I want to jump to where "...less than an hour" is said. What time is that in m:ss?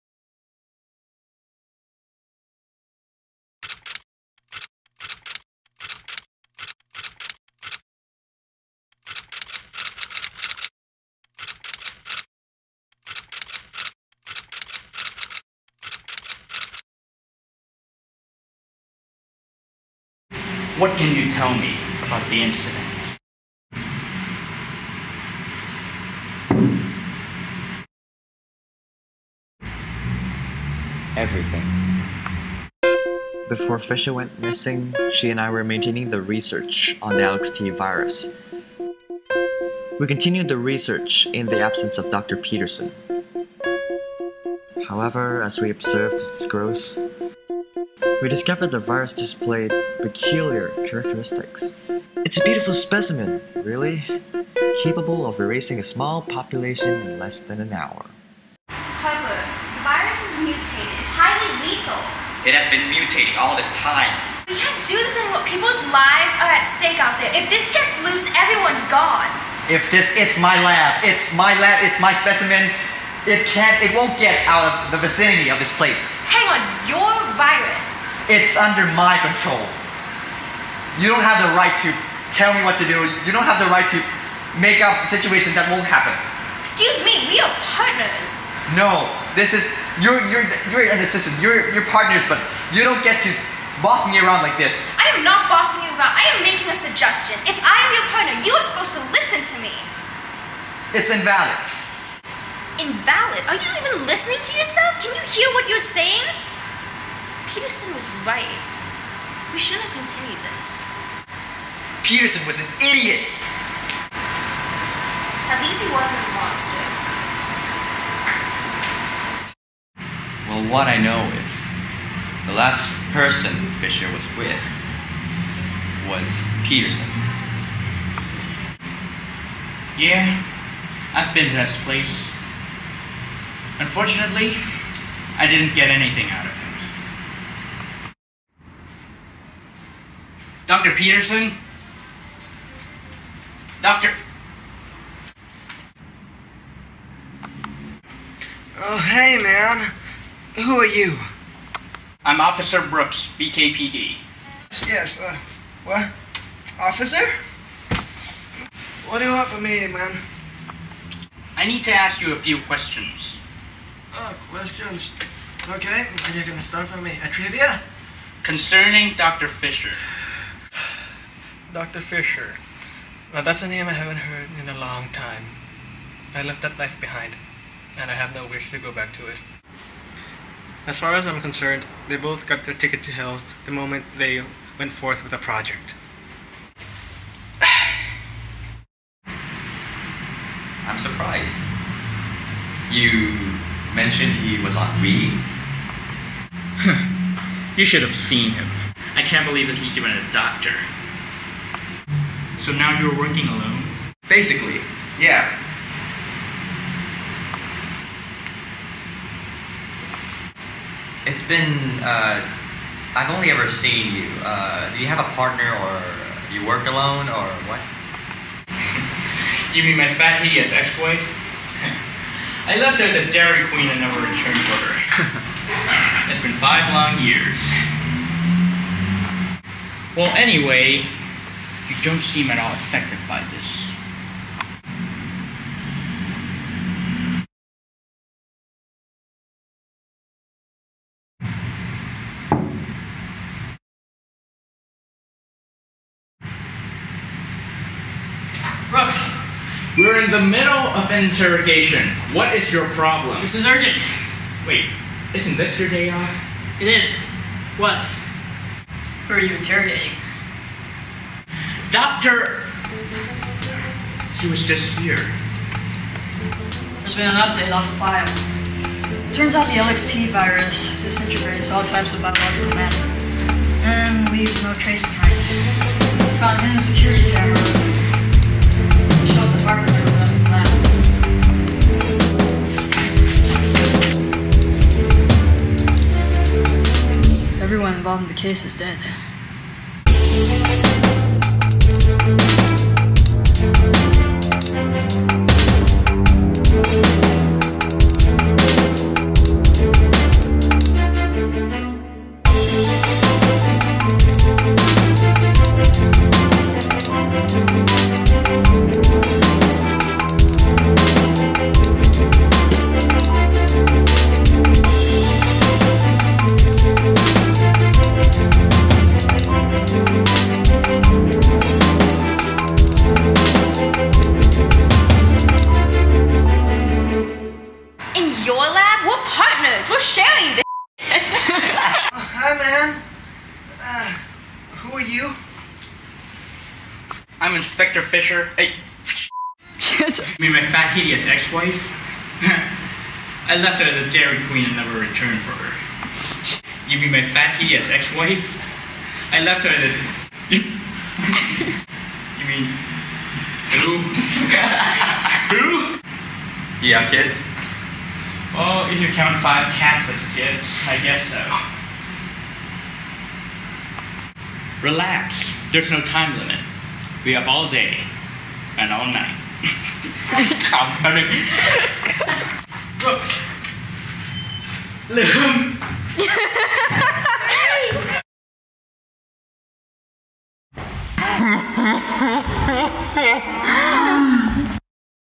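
0:57.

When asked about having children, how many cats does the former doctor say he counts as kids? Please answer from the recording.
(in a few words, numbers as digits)
5.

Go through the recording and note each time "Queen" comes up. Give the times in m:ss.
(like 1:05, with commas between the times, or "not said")
3:43, 5:44.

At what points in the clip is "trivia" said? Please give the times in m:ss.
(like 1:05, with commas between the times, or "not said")
2:47.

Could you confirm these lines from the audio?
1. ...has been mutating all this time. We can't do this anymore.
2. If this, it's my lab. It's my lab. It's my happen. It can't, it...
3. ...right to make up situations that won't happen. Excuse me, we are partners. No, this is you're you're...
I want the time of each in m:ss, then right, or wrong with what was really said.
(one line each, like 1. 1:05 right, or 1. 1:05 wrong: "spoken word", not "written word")
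1. 1:02 right
2. 1:09 wrong: "specimen", not "happen"
3. 1:23 right.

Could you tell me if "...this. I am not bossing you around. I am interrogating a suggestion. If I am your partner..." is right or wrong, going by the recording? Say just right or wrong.
wrong.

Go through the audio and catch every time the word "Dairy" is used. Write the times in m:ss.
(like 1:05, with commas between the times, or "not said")
3:43, 5:44.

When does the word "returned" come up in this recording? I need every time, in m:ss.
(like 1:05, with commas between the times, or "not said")
3:44, 5:44.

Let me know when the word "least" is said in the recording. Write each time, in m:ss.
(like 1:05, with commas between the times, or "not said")
1:55.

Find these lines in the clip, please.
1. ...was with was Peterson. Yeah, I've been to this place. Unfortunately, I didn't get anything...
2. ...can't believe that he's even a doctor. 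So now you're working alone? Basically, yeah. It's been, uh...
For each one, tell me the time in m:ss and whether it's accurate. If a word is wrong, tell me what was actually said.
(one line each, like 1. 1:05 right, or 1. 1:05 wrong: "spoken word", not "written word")
1. 2:04 right
2. 3:19 right.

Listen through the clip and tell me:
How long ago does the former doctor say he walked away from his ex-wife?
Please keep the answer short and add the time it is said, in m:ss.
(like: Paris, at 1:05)
5 years, at 3:46.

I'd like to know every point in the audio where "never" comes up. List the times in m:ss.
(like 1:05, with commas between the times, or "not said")
3:44, 5:44.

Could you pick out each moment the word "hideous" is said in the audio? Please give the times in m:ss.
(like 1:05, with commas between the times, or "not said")
3:40, 5:40, 5:47.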